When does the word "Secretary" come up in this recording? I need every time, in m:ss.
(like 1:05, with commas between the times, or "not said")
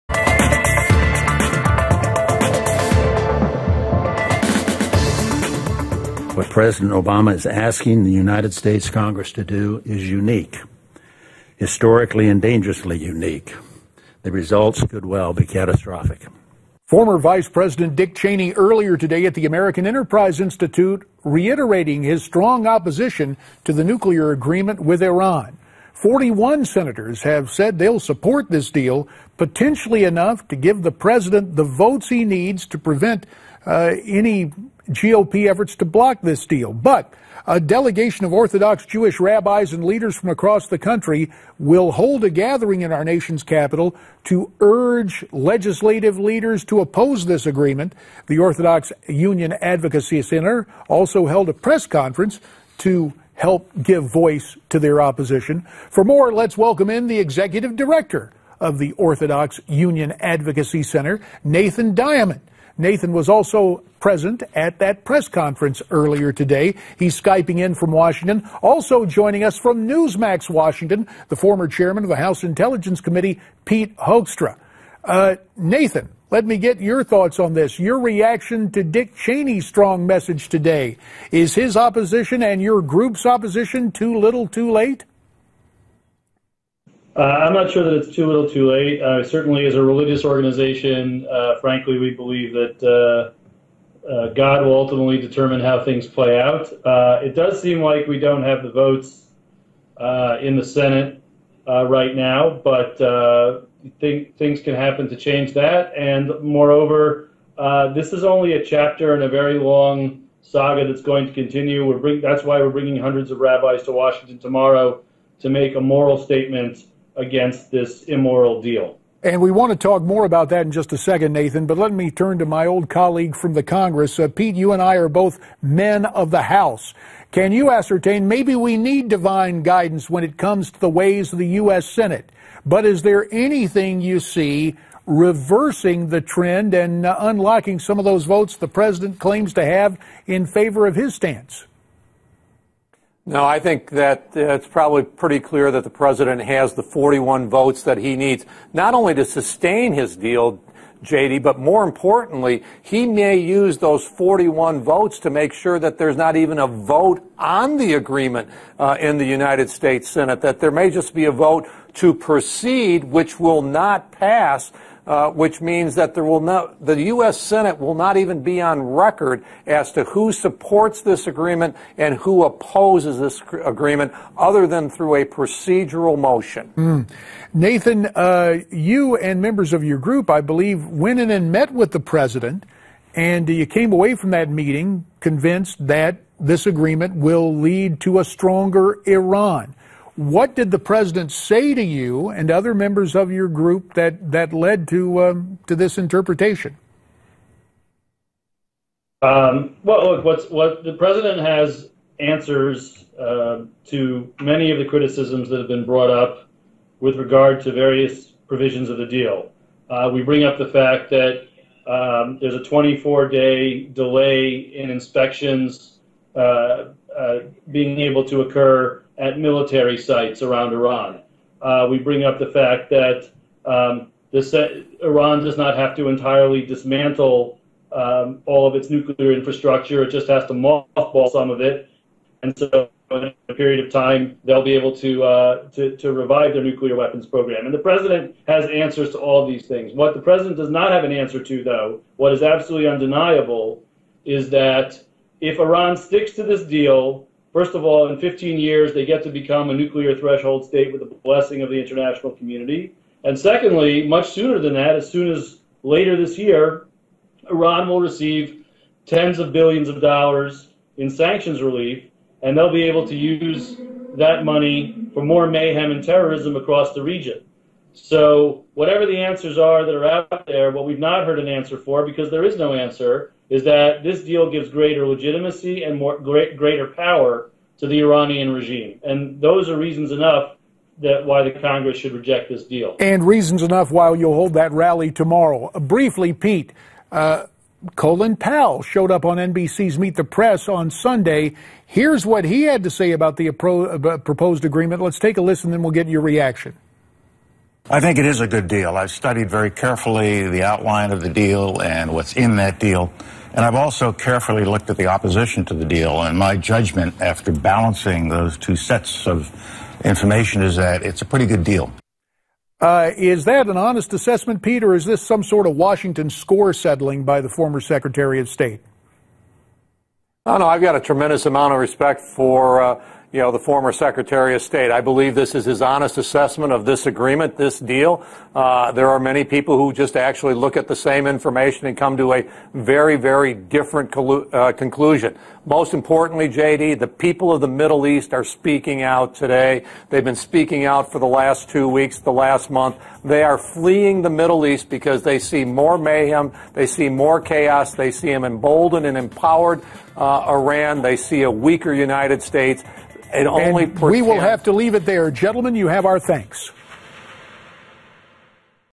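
5:17, 5:23.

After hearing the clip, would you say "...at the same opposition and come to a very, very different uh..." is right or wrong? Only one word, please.
wrong.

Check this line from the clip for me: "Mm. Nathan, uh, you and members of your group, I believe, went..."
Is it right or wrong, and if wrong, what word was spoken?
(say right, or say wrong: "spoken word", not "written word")
right.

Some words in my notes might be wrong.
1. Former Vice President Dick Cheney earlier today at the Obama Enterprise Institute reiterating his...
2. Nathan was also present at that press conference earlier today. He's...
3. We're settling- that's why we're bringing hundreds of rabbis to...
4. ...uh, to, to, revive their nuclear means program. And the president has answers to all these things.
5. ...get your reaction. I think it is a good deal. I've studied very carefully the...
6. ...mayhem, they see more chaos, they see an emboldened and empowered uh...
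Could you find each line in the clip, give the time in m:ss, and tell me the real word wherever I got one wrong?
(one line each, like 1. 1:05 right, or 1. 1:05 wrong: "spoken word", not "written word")
1. 0:16 wrong: "American", not "Obama"
2. 1:02 right
3. 1:51 wrong: "bring", not "settling"
4. 3:55 wrong: "weapons", not "means"
5. 4:55 right
6. 5:45 right.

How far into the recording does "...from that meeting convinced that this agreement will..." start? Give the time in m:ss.
3:04.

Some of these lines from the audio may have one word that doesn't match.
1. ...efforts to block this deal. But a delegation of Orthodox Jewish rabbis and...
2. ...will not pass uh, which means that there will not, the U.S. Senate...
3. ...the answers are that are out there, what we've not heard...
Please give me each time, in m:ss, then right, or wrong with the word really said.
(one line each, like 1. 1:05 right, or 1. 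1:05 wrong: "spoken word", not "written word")
1. 0:35 right
2. 2:43 right
3. 4:29 right.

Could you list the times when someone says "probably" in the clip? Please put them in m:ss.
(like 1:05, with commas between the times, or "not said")
2:24.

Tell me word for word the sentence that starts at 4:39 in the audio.
And those are reasons enough that why the Congress should reject this deal.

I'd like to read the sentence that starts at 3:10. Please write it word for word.
What did the president say to you and other members of your group that, that led to, um, to this interpretation?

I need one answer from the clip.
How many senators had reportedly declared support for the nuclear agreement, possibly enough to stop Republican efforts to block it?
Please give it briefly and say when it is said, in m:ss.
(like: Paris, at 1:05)
41, at 0:25.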